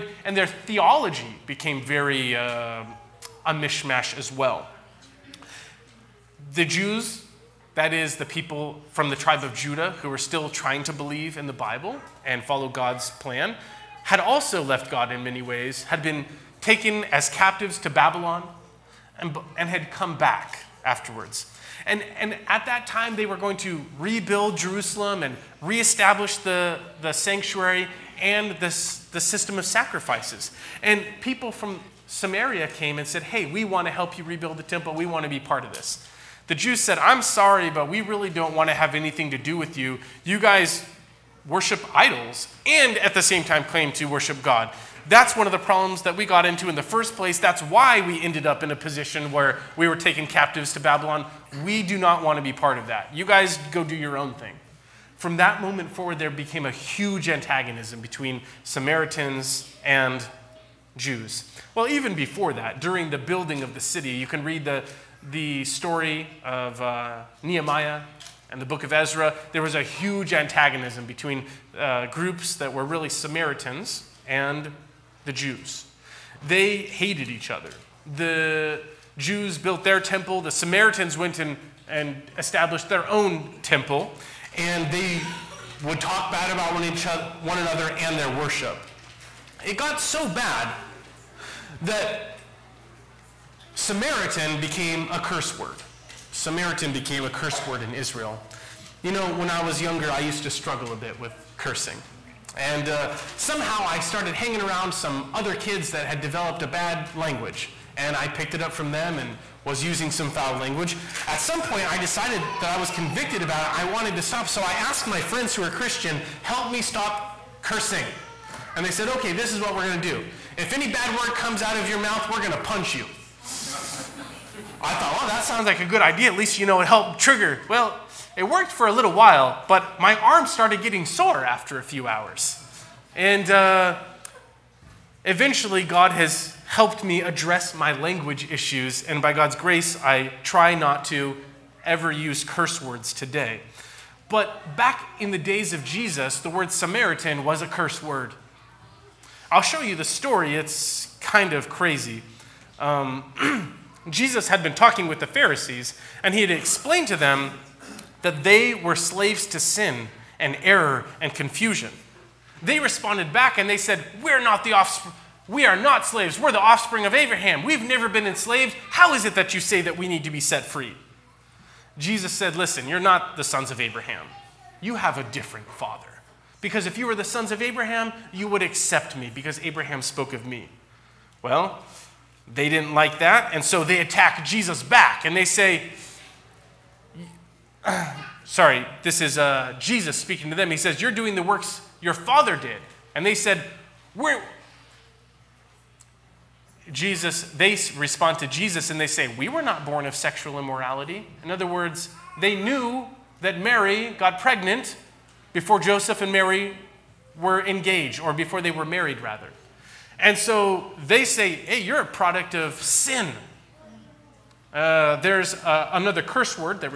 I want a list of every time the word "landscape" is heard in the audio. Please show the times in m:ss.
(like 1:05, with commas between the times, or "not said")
not said.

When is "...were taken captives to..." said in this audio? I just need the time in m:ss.
0:49.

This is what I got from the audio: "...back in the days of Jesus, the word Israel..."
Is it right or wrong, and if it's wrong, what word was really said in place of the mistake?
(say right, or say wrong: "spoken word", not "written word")
wrong: "Samaritan", not "Israel".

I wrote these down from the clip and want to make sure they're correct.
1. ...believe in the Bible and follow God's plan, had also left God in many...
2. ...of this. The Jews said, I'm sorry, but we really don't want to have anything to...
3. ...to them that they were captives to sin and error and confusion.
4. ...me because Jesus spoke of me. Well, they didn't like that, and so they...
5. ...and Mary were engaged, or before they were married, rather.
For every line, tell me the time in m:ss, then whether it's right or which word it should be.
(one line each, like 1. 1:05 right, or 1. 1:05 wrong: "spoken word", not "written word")
1. 0:10 right
2. 0:35 right
3. 2:37 wrong: "slaves", not "captives"
4. 2:59 wrong: "Abraham", not "Jesus"
5. 3:26 right.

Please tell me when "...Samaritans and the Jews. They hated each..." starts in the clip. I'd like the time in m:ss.
1:13.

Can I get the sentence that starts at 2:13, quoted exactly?
And uh, eventually, God has helped me address my language issues.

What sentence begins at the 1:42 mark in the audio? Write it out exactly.
And uh, somehow I started hanging around some other kids that had developed a bad language.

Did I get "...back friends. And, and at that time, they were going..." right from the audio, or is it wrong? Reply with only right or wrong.
wrong.